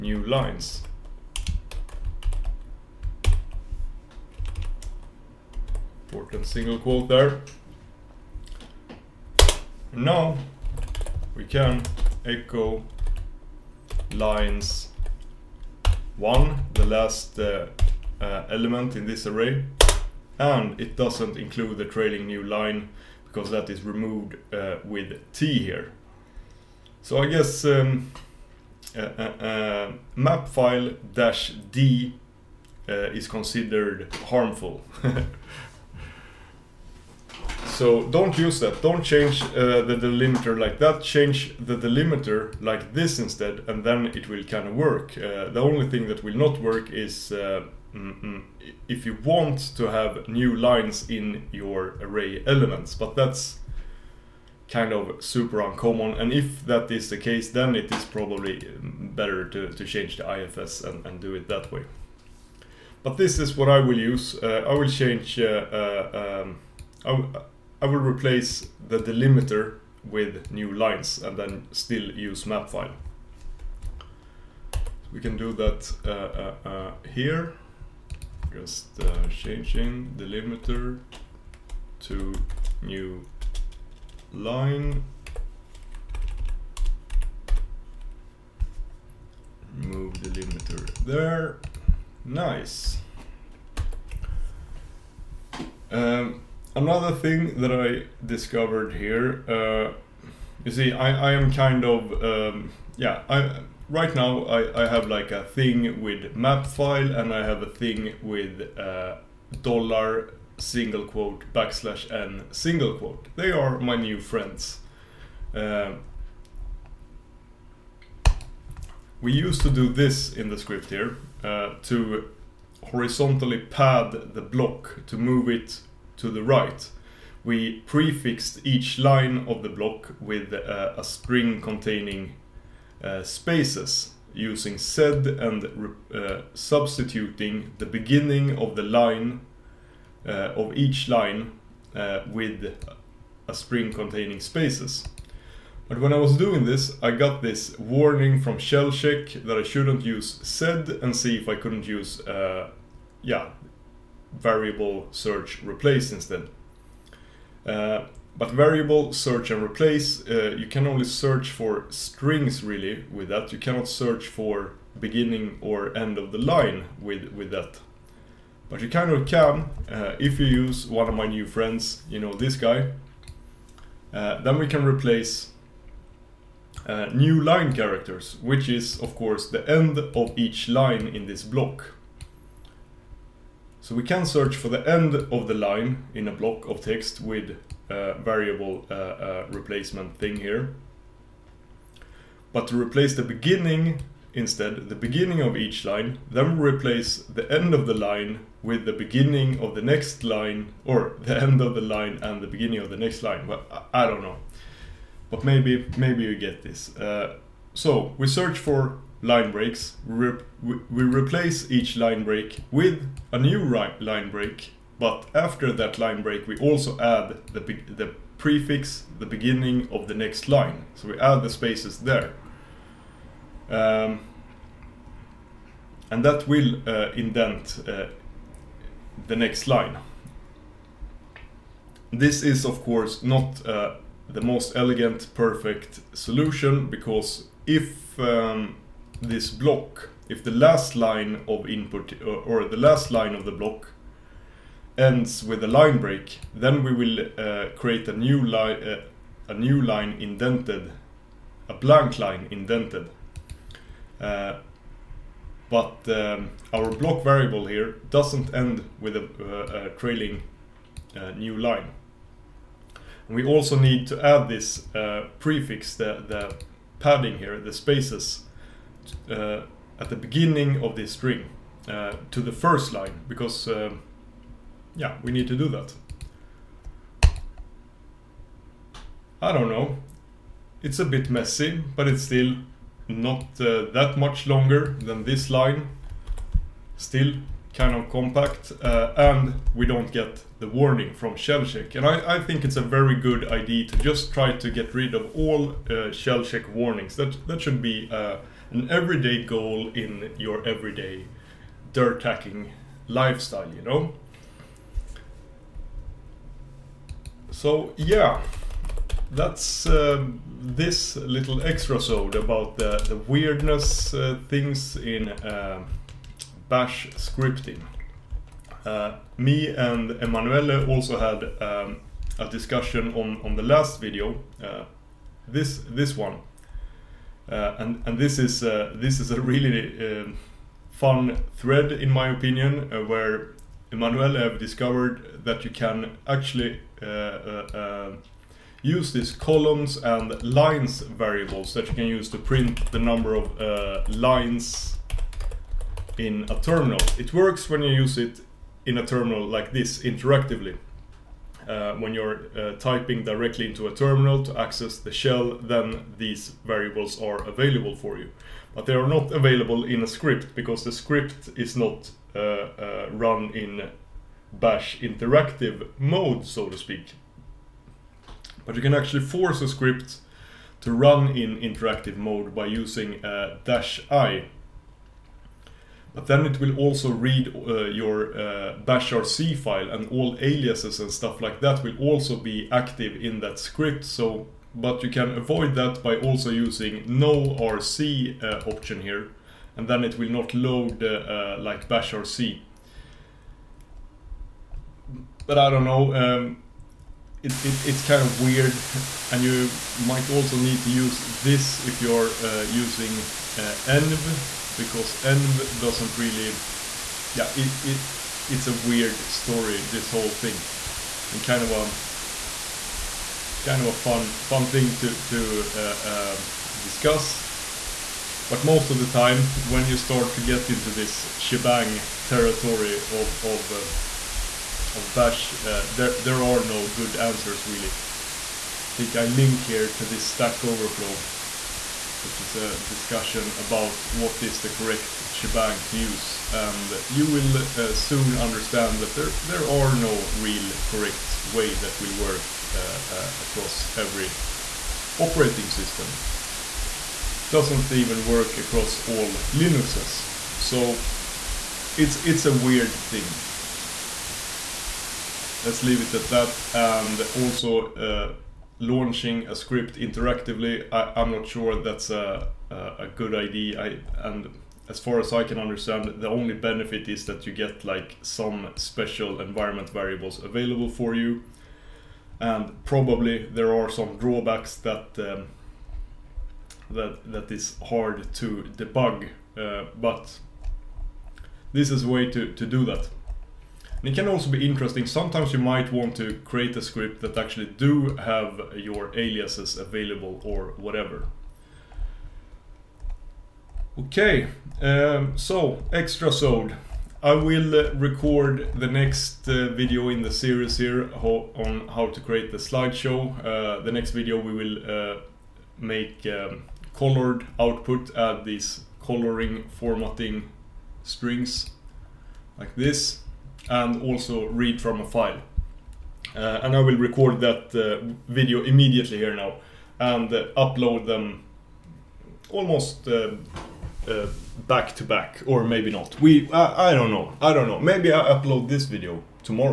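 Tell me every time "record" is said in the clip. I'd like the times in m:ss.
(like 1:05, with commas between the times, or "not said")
8:17, 8:36.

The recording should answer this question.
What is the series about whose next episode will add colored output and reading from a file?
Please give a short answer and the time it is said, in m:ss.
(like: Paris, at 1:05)
slideshow, at 8:22.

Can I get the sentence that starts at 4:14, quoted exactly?
Uh, but um, our block variable here doesn't end with a, uh, trailing uh, new line.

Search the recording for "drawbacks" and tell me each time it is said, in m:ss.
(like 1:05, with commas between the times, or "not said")
7:54.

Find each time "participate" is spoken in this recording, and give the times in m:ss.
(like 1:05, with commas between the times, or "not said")
not said.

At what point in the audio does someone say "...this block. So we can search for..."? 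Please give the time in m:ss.
3:01.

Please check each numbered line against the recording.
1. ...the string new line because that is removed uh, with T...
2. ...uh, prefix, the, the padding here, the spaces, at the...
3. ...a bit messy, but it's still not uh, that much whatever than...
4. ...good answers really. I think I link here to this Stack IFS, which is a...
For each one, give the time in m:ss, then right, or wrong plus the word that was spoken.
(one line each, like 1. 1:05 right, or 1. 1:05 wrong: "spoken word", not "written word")
1. 0:21 wrong: "trailing", not "string"
2. 4:24 right
3. 4:40 wrong: "longer", not "whatever"
4. 7:06 wrong: "Overflow", not "IFS".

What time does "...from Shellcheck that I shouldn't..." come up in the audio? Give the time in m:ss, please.
2:28.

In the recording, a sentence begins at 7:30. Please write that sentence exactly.
So it's it's a weird thing.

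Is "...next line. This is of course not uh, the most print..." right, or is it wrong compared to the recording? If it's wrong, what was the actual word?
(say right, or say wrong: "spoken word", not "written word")
wrong: "elegant", not "print".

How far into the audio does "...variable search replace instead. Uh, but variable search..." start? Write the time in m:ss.
2:34.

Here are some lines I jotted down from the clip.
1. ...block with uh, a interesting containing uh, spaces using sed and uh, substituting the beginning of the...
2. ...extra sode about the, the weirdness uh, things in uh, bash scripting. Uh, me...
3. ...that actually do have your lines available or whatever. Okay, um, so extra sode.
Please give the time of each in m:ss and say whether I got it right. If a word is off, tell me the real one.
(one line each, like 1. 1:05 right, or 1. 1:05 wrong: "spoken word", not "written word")
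1. 2:09 wrong: "string", not "interesting"
2. 5:11 right
3. 8:07 wrong: "aliases", not "lines".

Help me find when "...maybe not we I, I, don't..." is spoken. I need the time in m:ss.
8:45.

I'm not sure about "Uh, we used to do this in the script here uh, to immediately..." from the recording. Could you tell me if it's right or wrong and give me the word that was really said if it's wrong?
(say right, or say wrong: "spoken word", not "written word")
wrong: "horizontally", not "immediately".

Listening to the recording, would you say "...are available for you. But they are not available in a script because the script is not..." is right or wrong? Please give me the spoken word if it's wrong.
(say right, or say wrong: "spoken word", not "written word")
right.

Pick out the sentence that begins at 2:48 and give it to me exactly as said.
But you kind of can uh, if you use one of my new friends, you know, this guy.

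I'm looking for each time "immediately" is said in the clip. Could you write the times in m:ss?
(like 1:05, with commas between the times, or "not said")
8:38.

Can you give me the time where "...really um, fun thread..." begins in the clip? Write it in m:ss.
5:29.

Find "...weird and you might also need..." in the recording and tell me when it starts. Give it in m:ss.
6:38.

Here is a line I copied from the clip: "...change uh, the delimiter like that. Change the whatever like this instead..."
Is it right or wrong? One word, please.
wrong.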